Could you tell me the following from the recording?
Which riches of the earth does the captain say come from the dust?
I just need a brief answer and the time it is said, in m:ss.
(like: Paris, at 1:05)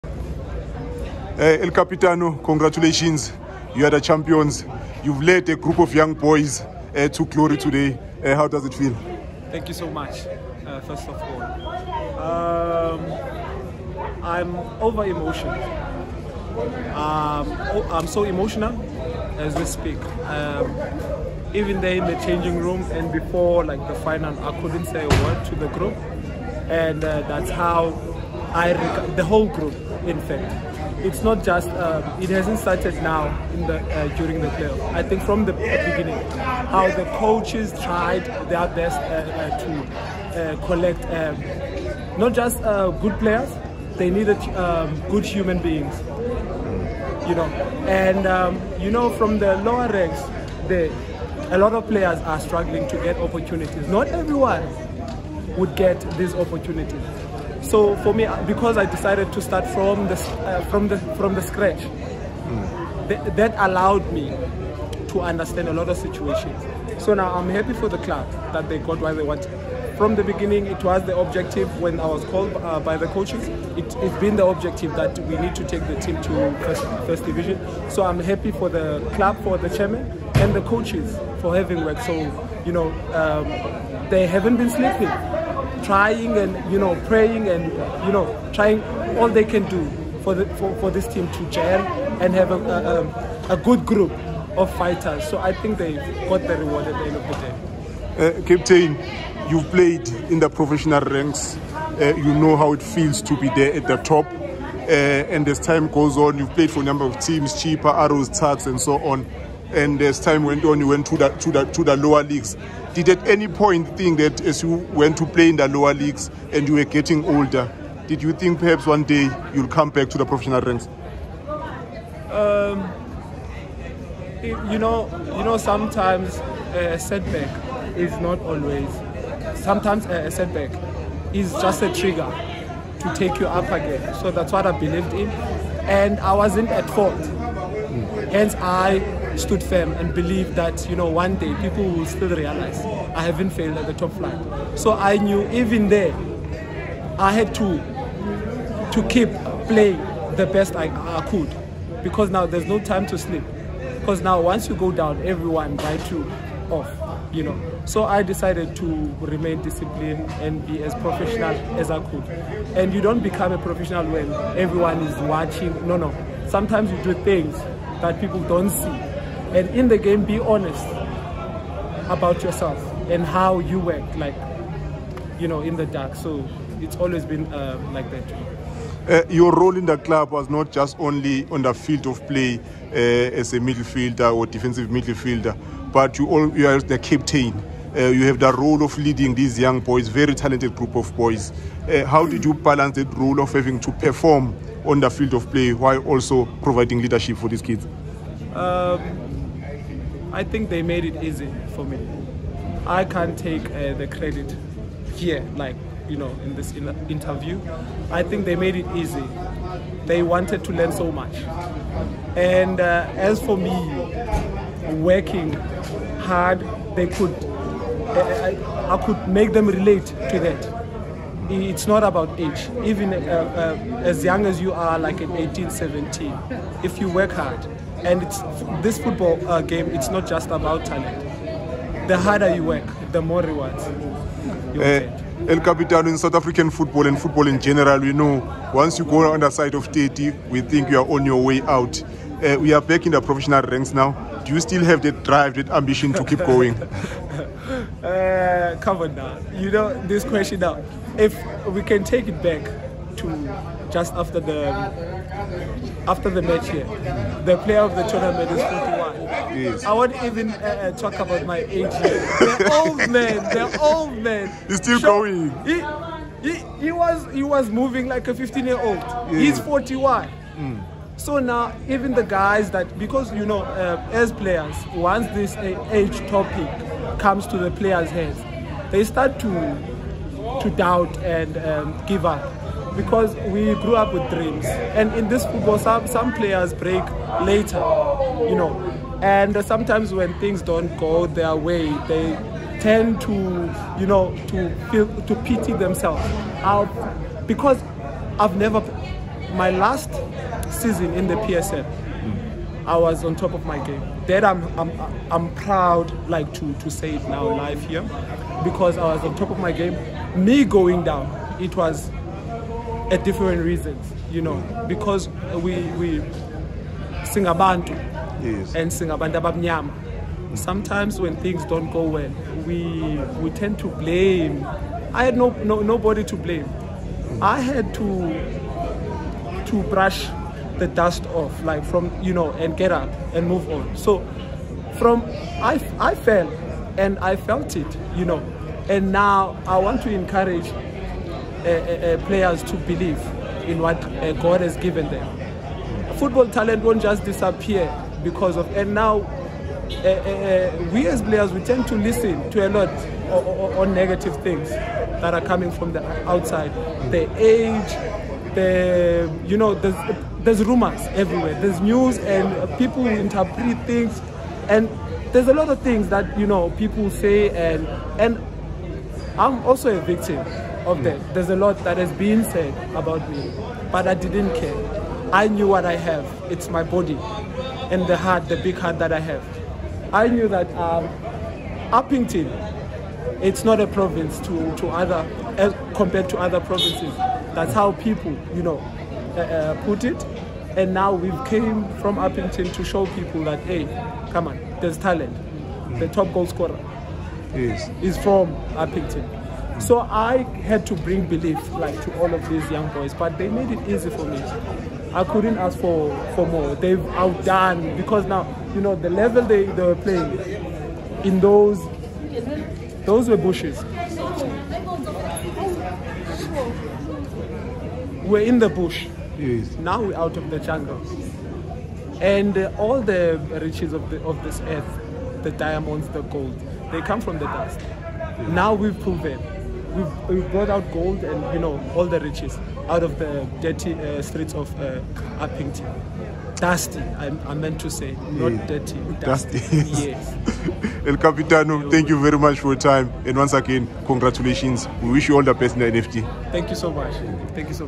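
Diamonds, at 7:05.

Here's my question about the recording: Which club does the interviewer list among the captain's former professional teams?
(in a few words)
Chippa.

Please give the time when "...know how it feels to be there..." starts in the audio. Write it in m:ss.
1:42.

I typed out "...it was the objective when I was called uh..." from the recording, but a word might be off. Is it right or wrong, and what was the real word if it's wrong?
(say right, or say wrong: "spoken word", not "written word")
right.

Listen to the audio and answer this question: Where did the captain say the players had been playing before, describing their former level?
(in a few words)
The bush.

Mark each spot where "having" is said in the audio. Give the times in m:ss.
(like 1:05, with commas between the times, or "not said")
1:21, 3:13.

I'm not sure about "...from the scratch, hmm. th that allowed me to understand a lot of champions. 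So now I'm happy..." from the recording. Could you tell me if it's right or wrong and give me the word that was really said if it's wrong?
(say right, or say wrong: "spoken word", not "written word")
wrong: "situations", not "champions".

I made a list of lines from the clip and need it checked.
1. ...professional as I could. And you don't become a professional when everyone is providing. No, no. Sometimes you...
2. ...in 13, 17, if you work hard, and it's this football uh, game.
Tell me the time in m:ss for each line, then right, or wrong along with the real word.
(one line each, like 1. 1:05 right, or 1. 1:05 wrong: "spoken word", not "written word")
1. 2:40 wrong: "watching", not "providing"
2. 3:45 wrong: "18", not "13".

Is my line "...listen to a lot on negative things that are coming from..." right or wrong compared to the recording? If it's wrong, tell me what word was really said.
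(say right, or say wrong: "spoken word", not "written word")
right.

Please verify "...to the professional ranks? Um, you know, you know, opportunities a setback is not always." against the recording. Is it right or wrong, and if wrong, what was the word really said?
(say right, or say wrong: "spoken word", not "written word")
wrong: "sometimes", not "opportunities".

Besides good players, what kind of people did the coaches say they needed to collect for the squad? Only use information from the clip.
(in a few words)
Good human beings.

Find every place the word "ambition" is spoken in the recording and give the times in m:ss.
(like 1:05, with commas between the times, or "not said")
4:05.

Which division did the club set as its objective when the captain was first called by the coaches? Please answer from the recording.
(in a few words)
First division.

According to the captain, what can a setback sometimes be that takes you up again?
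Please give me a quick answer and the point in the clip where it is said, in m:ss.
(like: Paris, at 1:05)
A trigger, at 2:11.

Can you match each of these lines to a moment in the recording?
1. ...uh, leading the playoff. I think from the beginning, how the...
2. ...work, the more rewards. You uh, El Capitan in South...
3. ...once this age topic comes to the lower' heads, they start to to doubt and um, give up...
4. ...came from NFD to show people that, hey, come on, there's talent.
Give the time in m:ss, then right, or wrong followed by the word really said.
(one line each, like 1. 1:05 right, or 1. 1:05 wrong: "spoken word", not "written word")
1. 0:33 wrong: "during", not "leading"
2. 3:52 right
3. 4:34 wrong: "players", not "lower"
4. 6:31 wrong: "Upington", not "NFD".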